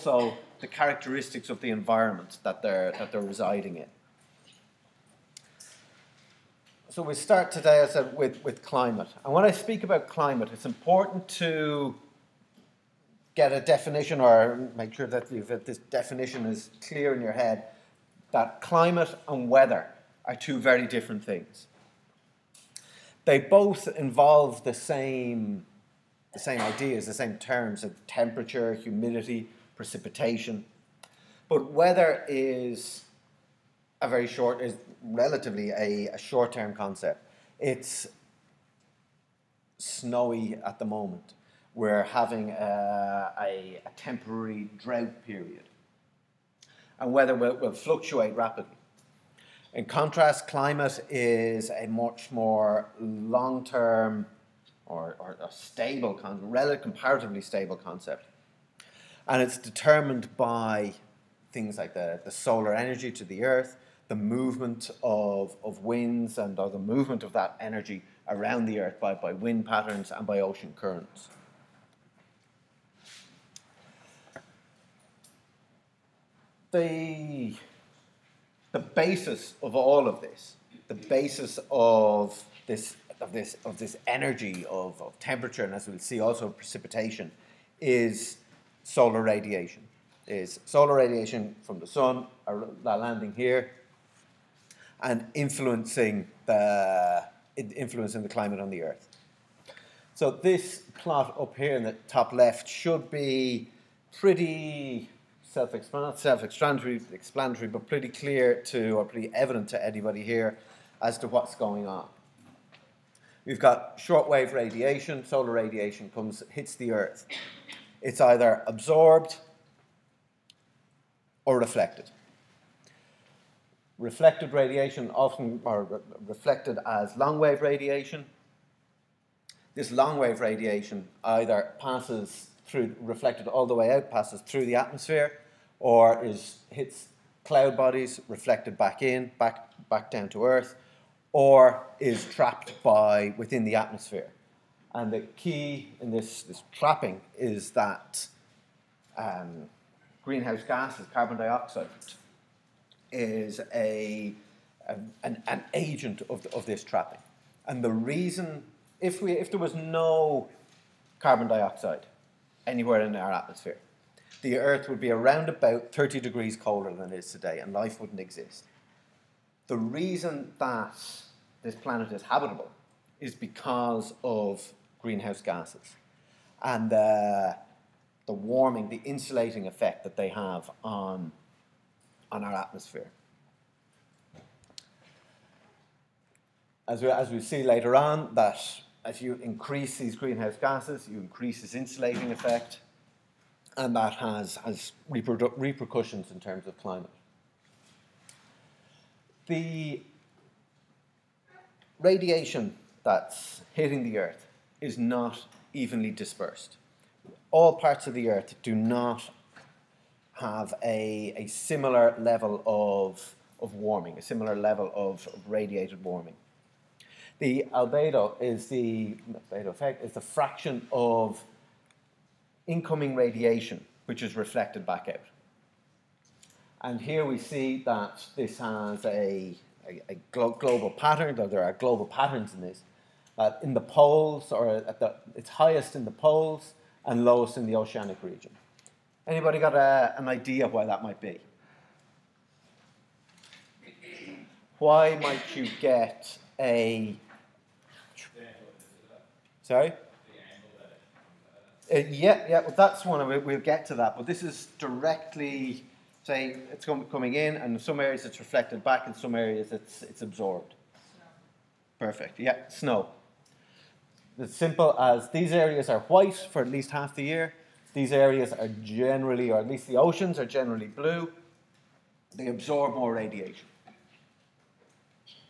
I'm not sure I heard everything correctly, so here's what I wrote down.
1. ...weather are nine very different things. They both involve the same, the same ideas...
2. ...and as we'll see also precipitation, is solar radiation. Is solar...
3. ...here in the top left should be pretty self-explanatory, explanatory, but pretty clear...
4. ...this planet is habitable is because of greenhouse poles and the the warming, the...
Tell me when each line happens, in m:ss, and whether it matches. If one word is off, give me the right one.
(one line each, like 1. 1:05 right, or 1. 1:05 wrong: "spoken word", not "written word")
1. 0:19 wrong: "two", not "nine"
2. 1:25 right
3. 1:41 right
4. 2:51 wrong: "gases", not "poles".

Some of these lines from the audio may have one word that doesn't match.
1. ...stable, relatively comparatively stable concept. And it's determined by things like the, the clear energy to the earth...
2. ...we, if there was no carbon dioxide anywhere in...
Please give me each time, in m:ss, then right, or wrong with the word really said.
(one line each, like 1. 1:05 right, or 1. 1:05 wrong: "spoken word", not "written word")
1. 0:55 wrong: "solar", not "clear"
2. 2:39 right.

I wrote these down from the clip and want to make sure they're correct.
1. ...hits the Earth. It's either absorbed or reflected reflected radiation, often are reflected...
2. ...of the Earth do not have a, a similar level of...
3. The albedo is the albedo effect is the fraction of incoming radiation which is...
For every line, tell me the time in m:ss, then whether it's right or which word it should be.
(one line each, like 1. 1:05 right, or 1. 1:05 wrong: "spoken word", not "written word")
1. 1:56 right
2. 3:28 right
3. 3:37 right.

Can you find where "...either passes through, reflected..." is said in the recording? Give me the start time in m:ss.
2:11.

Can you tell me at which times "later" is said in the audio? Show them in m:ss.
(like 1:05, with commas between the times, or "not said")
3:07.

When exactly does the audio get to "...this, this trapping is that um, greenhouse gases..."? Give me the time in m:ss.
2:26.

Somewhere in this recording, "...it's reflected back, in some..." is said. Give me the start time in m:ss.
4:18.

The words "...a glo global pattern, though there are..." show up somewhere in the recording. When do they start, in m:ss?
3:50.